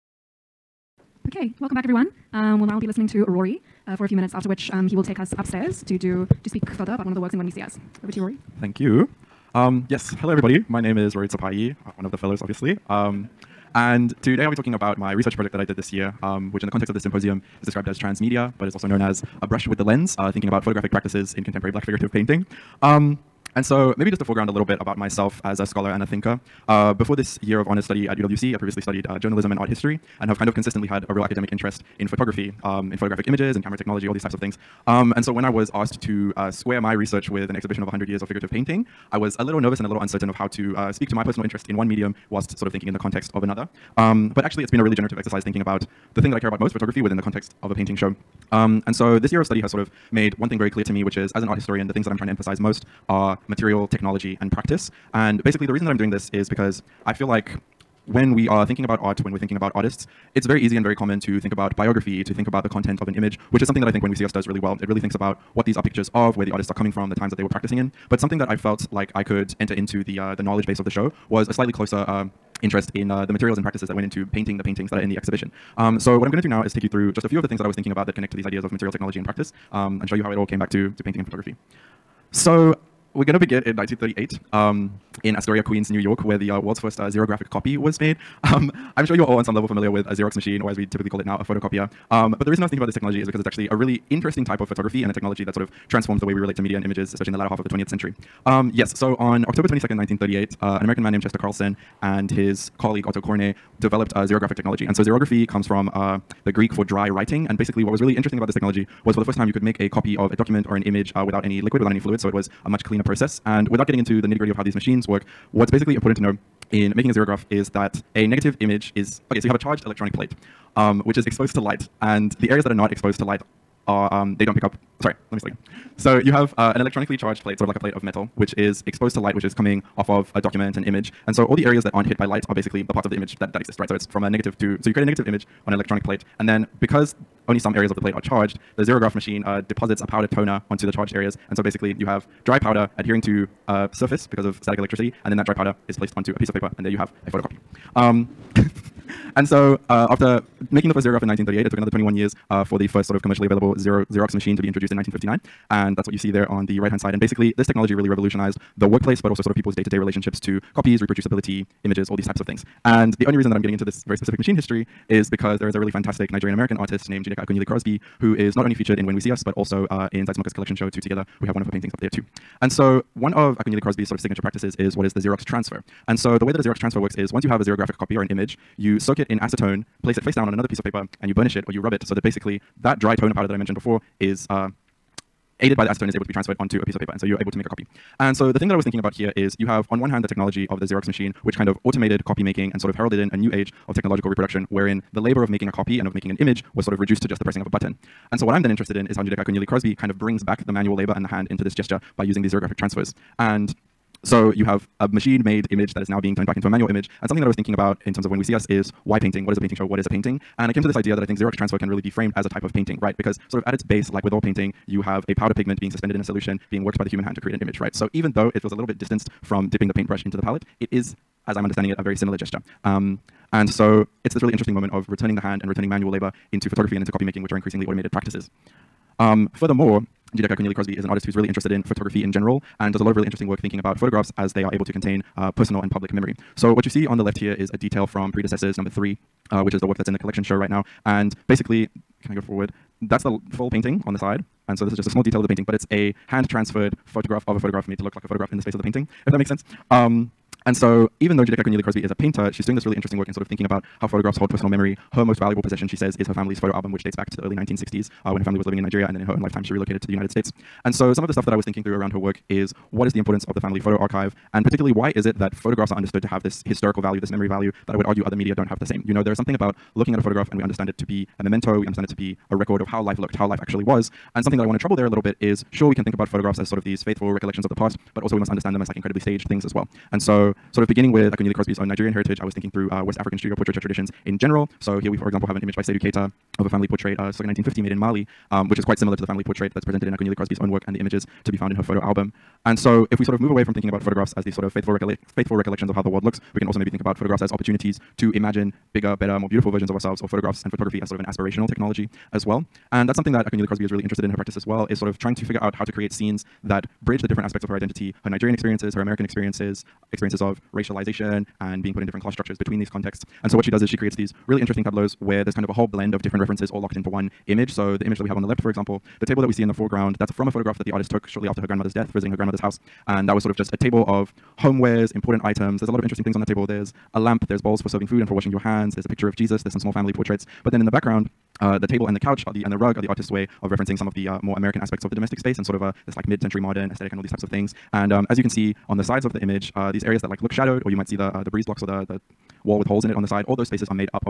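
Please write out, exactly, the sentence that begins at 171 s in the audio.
We have one of her paintings up there too.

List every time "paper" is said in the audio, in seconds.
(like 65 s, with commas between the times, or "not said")
146 s, 180 s, 186 s.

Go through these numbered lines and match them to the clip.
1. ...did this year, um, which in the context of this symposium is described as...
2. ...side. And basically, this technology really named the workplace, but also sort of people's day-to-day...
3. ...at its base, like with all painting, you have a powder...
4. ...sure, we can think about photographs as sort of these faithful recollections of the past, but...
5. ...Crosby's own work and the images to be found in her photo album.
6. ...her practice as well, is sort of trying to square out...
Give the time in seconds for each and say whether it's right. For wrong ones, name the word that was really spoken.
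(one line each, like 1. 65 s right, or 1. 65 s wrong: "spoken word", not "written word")
1. 15 s right
2. 156 s wrong: "revolutionized", not "named"
3. 213 s right
4. 275 s right
5. 290 s right
6. 304 s wrong: "figure", not "square".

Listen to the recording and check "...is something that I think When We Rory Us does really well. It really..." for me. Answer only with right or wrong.
wrong.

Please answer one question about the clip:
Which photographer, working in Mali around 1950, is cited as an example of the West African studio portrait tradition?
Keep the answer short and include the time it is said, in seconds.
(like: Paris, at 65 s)
Seydou Keita, at 285 s.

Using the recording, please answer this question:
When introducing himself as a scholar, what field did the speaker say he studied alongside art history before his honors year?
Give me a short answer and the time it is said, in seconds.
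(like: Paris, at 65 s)
Journalism, at 29 s.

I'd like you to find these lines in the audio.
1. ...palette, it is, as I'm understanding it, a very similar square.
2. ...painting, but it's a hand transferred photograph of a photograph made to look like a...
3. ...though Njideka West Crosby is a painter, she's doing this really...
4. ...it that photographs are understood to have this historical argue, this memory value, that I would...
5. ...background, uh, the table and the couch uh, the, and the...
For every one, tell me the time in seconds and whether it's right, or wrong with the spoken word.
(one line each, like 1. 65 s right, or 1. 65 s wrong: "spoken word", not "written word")
1. 220 s wrong: "gesture", not "square"
2. 245 s right
3. 251 s wrong: "Akunyili", not "West"
4. 265 s wrong: "value", not "argue"
5. 330 s right.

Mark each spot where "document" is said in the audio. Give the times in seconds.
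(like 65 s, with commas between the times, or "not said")
110 s, 130 s.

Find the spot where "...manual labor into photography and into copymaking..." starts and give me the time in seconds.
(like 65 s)
225 s.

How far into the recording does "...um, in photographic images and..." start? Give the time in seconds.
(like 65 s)
32 s.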